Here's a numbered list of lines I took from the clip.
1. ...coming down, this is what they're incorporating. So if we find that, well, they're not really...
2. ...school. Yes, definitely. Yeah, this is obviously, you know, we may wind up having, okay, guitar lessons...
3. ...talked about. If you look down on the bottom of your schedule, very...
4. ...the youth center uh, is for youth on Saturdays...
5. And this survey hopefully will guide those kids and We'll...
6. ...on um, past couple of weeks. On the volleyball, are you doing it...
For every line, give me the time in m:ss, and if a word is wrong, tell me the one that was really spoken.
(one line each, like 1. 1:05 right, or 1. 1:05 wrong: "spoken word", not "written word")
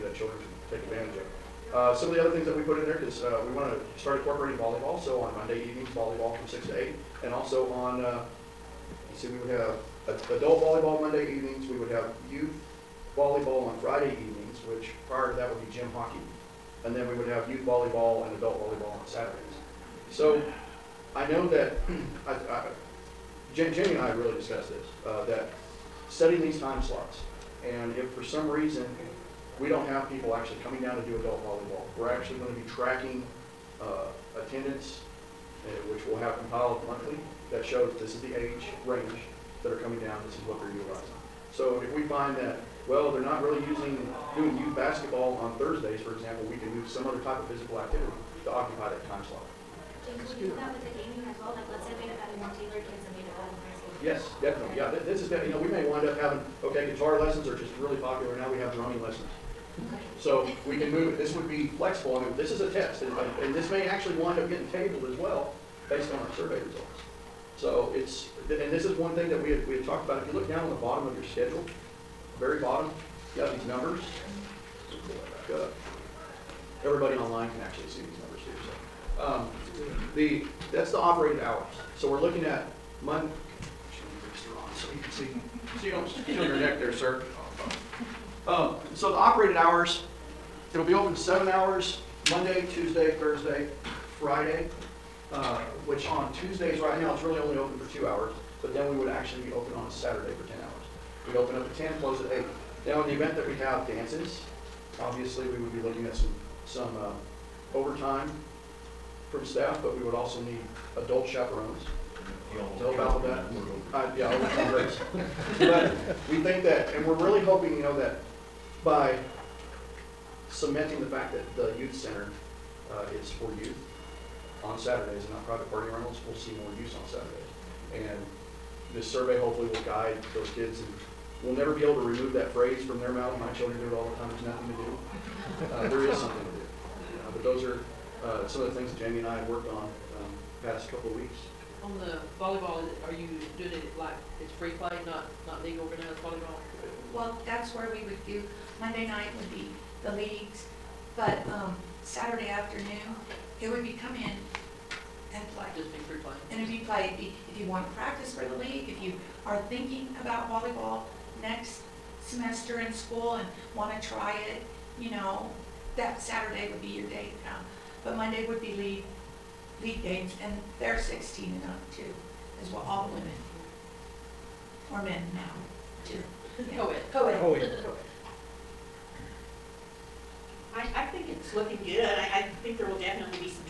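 1. 0:39 wrong: "utilizing", not "incorporating"
2. 0:53 wrong: "definitely", not "obviously"
3. 1:09 right
4. 2:01 right
5. 2:08 right
6. 2:19 right.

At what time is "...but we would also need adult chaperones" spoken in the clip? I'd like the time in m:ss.
1:49.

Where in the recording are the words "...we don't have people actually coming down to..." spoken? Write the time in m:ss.
0:29.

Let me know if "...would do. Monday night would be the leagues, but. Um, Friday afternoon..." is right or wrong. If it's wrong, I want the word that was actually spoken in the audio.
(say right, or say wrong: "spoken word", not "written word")
wrong: "Saturday", not "Friday".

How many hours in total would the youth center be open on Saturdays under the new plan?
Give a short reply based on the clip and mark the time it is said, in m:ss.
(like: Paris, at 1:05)
10, at 1:40.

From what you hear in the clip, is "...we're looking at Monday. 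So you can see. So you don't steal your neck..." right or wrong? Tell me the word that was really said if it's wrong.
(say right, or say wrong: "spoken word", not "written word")
right.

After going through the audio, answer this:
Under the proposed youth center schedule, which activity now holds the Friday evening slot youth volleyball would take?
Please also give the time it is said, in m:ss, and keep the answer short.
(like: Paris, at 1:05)
gym hockey, at 0:15.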